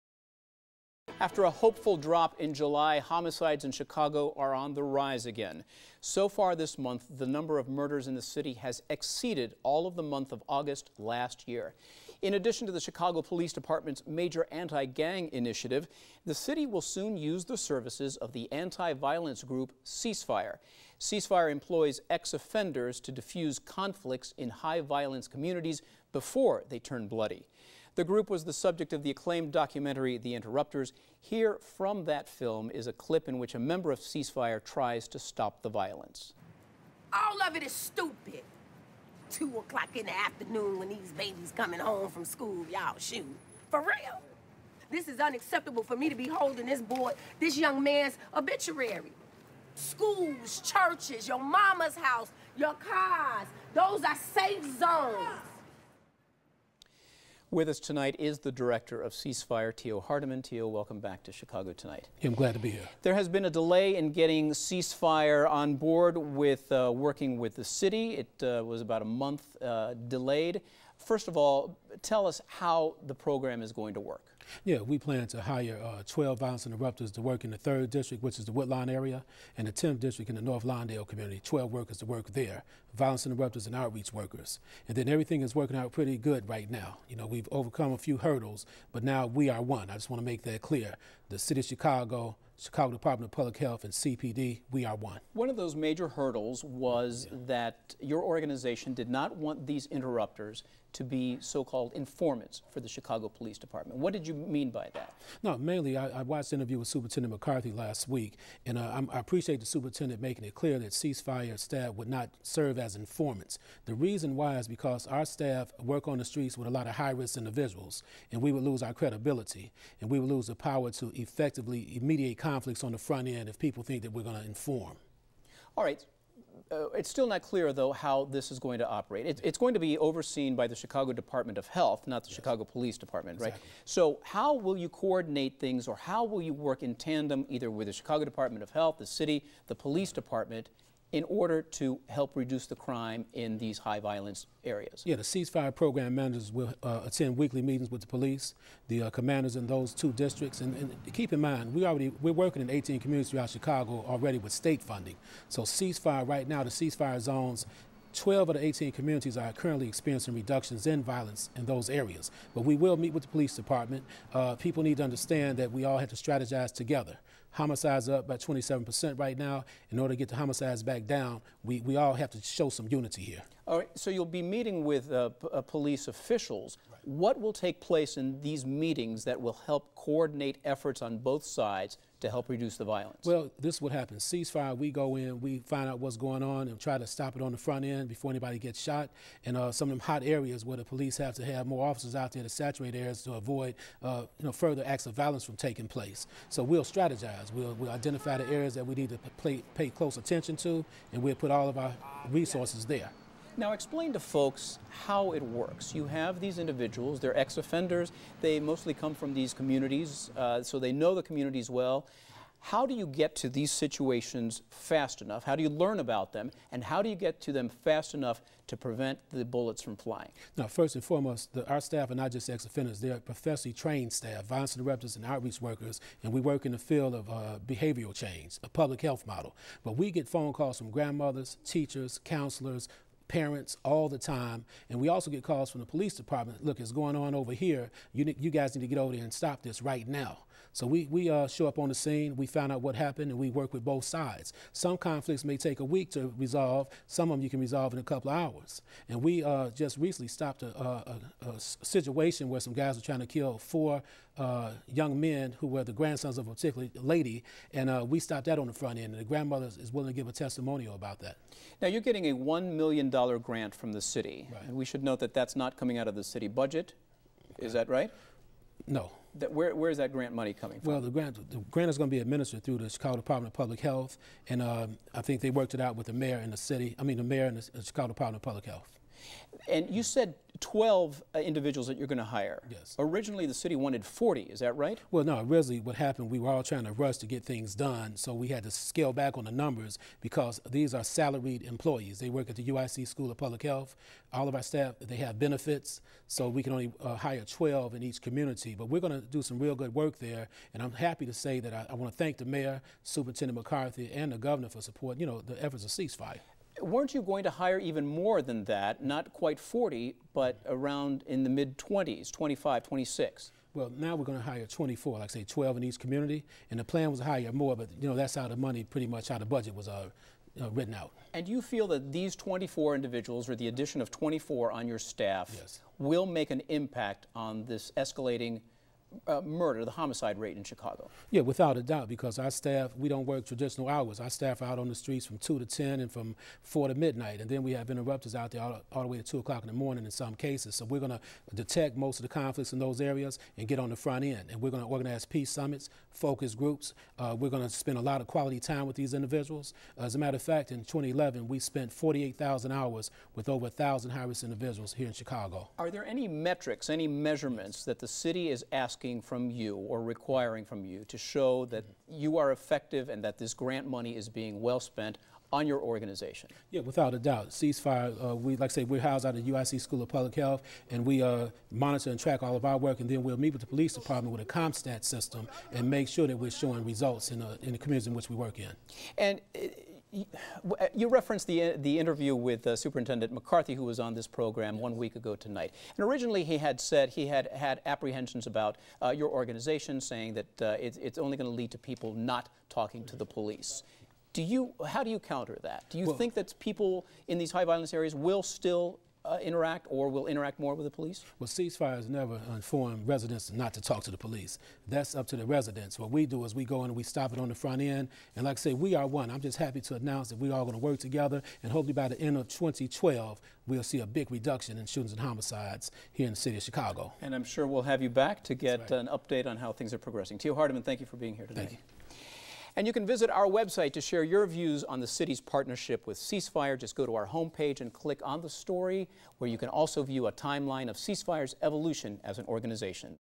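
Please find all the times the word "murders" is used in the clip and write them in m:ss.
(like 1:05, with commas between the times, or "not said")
0:07, 5:29.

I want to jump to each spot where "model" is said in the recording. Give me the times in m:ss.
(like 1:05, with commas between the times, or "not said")
3:49.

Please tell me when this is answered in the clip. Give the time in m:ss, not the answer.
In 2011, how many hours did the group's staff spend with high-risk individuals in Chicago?
5:51.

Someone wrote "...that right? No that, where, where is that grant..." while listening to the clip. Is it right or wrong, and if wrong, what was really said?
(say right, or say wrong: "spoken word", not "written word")
right.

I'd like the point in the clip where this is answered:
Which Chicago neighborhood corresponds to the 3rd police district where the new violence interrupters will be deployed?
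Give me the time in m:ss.
1:18.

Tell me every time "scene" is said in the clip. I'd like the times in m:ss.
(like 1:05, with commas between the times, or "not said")
4:01.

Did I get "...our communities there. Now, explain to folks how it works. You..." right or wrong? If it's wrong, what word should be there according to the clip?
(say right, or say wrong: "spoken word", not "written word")
wrong: "resources", not "communities".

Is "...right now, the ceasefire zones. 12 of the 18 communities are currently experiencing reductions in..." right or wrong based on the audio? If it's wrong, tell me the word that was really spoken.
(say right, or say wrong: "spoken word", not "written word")
right.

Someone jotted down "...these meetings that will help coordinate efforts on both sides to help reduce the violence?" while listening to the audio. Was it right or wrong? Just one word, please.
right.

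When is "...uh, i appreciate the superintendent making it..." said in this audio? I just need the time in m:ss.
1:48.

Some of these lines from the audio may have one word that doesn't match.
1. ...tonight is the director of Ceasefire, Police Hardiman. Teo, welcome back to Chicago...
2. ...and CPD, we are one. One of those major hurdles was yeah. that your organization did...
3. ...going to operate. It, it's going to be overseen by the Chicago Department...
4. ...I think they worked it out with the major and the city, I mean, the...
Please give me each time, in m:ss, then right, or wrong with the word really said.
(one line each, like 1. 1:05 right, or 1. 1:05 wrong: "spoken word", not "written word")
1. 0:57 wrong: "Tio", not "Police"
2. 1:33 right
3. 2:08 right
4. 4:35 wrong: "mayor", not "major".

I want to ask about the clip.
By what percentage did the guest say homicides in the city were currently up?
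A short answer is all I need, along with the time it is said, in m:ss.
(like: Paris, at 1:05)
27%, at 2:48.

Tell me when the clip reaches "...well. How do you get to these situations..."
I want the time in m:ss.
3:31.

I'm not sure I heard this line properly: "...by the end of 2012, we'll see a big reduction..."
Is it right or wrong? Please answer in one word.
right.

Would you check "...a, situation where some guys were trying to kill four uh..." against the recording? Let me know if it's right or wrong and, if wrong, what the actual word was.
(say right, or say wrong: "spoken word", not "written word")
right.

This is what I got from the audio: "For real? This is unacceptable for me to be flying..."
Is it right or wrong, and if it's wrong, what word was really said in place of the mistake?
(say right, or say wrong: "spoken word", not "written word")
wrong: "holding", not "flying".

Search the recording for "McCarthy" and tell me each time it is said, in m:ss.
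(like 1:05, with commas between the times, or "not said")
1:47, 5:03, 6:23.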